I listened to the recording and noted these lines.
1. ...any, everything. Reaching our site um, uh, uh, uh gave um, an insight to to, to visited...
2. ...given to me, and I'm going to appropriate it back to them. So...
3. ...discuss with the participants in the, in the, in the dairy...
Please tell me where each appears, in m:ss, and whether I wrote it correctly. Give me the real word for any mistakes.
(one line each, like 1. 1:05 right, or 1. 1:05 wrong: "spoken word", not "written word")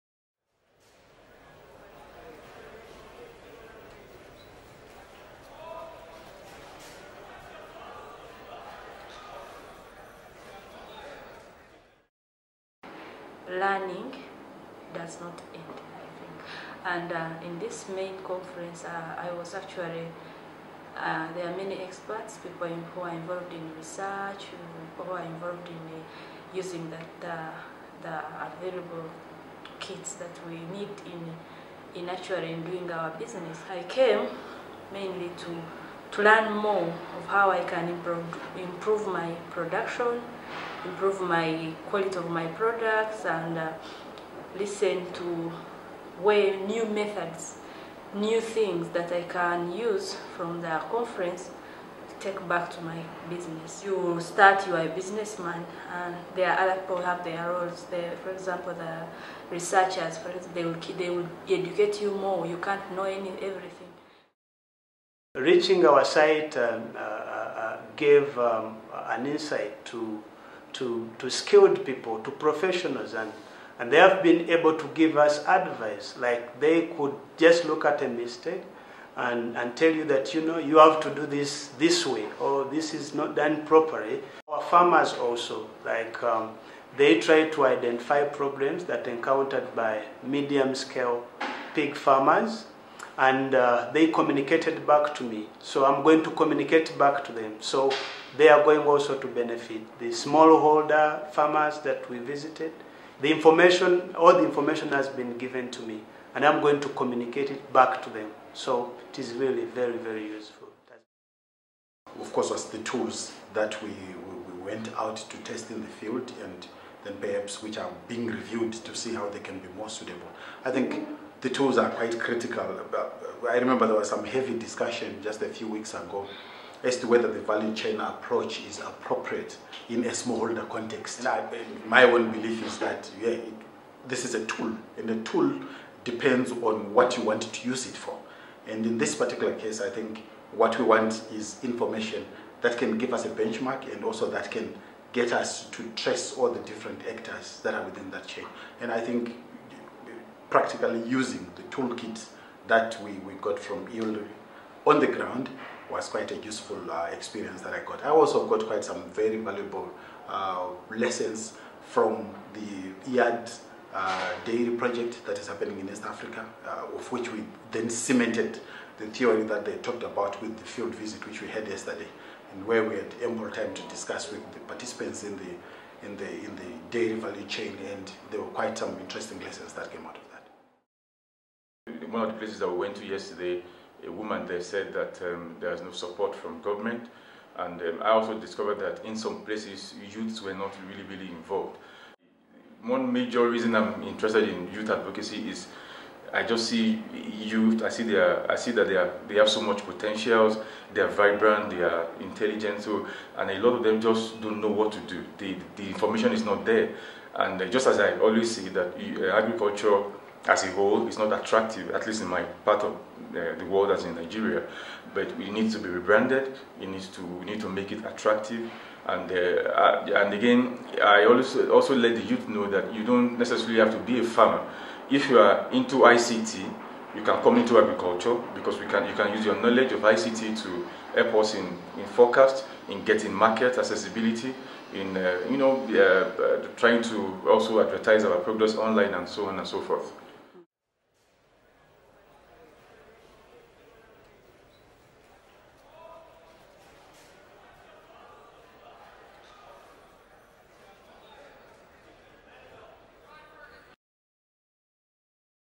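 1. 1:03 wrong: "skilled", not "visited"
2. 1:45 wrong: "communicate", not "appropriate"
3. 2:53 right.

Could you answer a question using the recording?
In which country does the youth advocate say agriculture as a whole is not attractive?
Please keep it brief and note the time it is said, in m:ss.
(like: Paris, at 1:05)
Nigeria, at 3:34.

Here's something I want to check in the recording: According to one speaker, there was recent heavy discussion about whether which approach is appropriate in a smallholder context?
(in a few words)
value chain approach.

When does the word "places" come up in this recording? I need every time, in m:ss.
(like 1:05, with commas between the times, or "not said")
3:02, 3:09.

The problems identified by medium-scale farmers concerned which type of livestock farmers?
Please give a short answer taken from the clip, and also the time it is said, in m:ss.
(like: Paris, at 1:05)
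pig farmers, at 1:31.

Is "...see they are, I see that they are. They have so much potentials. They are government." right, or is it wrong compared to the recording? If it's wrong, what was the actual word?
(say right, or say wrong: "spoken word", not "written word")
wrong: "vibrant", not "government".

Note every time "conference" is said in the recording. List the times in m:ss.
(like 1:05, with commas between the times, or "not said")
0:18, 0:50.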